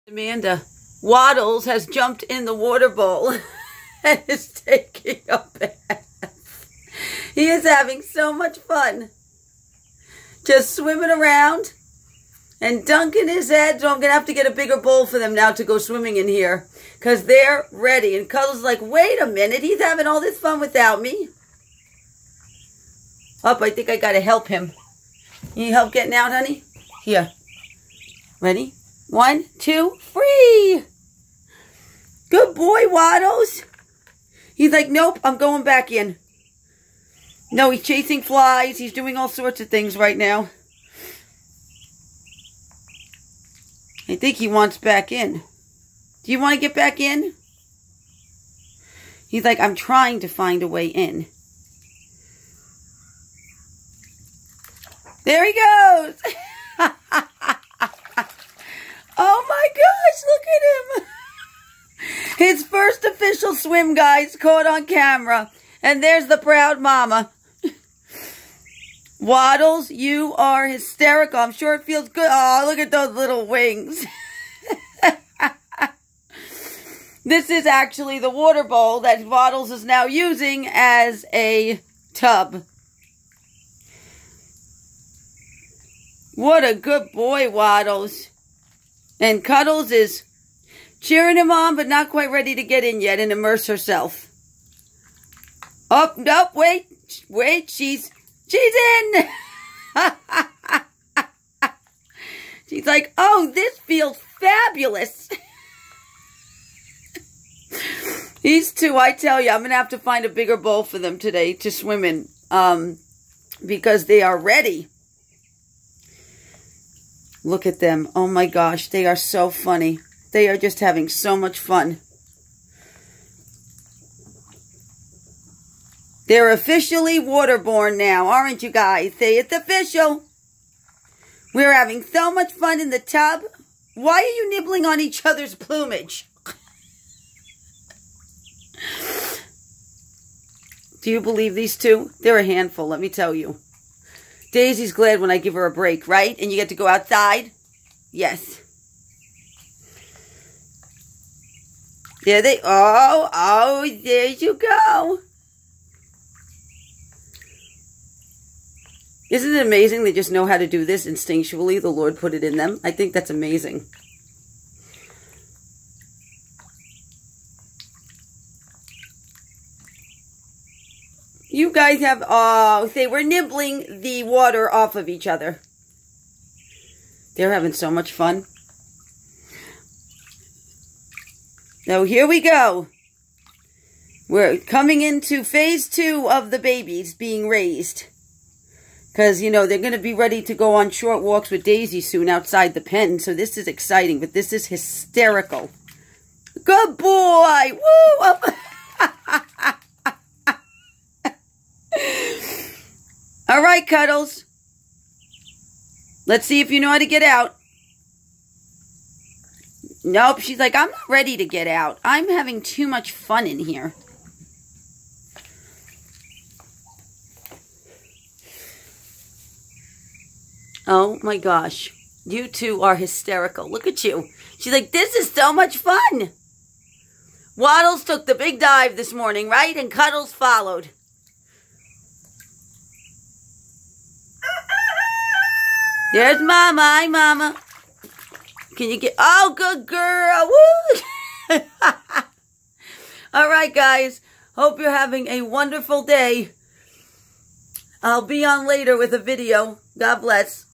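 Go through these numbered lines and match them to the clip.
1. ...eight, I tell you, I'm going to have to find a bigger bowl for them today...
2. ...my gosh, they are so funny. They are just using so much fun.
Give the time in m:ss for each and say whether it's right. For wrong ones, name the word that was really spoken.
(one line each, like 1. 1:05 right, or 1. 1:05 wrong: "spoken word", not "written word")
1. 1:48 wrong: "two", not "eight"
2. 1:58 wrong: "having", not "using".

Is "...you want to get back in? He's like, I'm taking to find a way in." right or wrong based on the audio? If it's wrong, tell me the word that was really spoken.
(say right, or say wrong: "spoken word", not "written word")
wrong: "trying", not "taking".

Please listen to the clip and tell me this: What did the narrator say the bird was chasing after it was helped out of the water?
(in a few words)
flies.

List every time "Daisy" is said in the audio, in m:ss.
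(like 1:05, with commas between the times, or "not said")
2:24, 3:11.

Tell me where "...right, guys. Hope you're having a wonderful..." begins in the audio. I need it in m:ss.
4:03.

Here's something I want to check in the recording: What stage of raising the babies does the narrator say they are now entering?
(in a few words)
phase two.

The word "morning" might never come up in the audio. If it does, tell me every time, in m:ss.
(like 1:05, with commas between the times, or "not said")
3:49.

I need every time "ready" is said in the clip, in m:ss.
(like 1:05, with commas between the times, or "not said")
0:17, 0:28, 1:32, 1:54, 3:10, 3:31.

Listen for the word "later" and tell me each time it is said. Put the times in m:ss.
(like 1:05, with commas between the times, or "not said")
4:08.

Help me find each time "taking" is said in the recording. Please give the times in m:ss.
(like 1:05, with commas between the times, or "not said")
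0:04.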